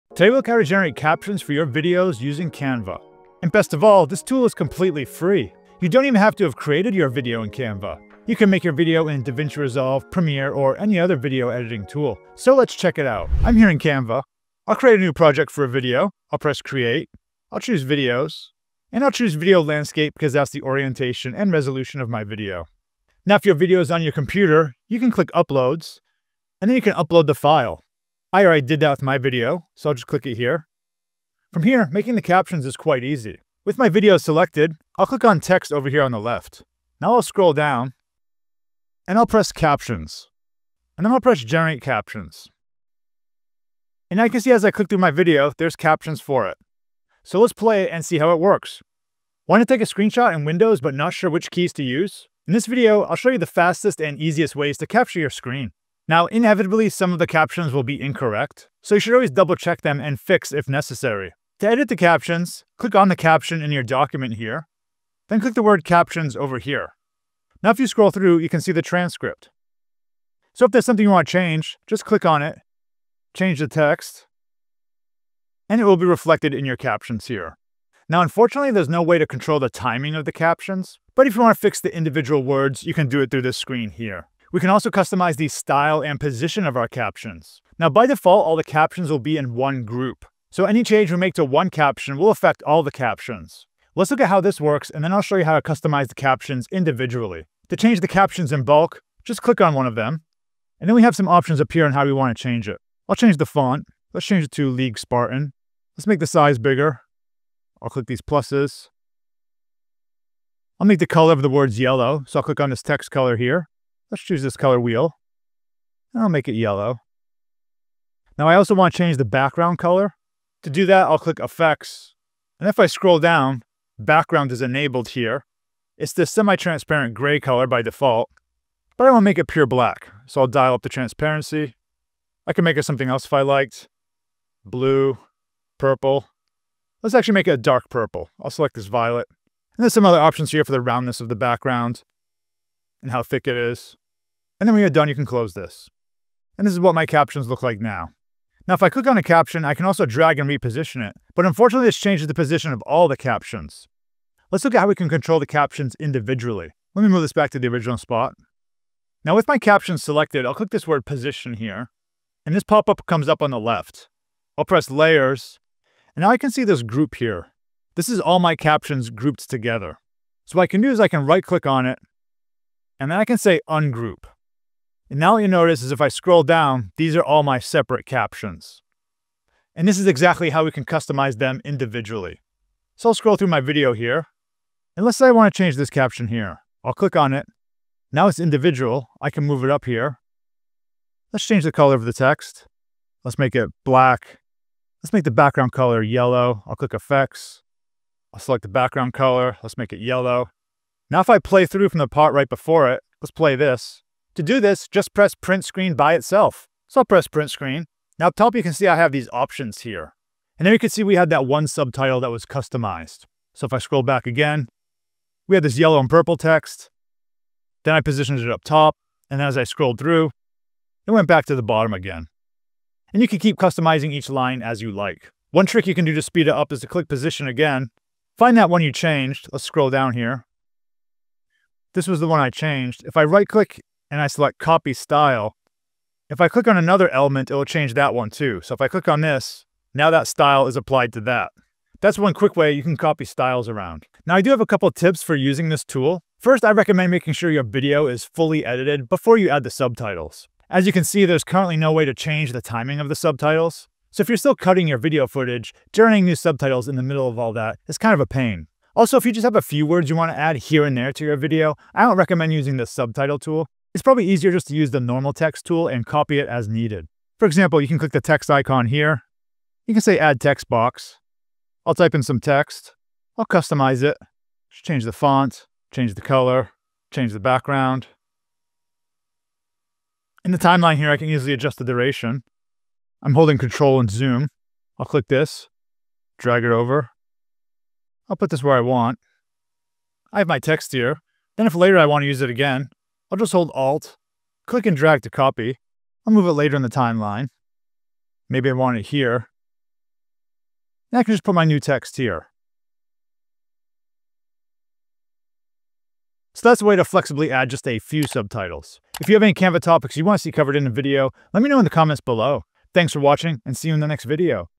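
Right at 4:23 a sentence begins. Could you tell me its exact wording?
It's probably easier just to use the normal text tool and copy it as needed.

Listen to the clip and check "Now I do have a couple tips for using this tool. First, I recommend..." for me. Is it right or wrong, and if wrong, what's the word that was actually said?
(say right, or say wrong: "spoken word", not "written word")
right.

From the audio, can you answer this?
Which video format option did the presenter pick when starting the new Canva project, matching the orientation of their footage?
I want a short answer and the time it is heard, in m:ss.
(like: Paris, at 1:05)
Video landscape, at 0:19.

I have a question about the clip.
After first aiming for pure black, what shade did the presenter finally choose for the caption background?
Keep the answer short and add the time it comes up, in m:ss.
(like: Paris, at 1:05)
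Violet, at 2:18.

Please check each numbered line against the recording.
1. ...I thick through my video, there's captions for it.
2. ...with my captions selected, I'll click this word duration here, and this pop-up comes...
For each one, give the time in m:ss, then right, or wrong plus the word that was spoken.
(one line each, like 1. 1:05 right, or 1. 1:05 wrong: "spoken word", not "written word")
1. 0:44 wrong: "click", not "thick"
2. 2:39 wrong: "position", not "duration".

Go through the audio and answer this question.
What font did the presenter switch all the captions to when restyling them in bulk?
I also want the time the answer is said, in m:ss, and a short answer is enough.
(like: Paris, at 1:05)
League Spartan, at 1:44.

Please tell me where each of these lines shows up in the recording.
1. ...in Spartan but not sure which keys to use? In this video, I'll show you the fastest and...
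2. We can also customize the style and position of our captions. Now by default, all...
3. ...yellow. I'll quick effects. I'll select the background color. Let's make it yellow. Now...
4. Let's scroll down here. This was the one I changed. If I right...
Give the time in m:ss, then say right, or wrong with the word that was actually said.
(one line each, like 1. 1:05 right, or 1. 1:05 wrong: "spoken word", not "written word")
1. 0:50 wrong: "Windows", not "Spartan"
2. 1:24 right
3. 3:16 wrong: "click", not "quick"
4. 3:49 right.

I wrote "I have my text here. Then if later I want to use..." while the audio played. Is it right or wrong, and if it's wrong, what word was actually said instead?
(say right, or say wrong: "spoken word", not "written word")
right.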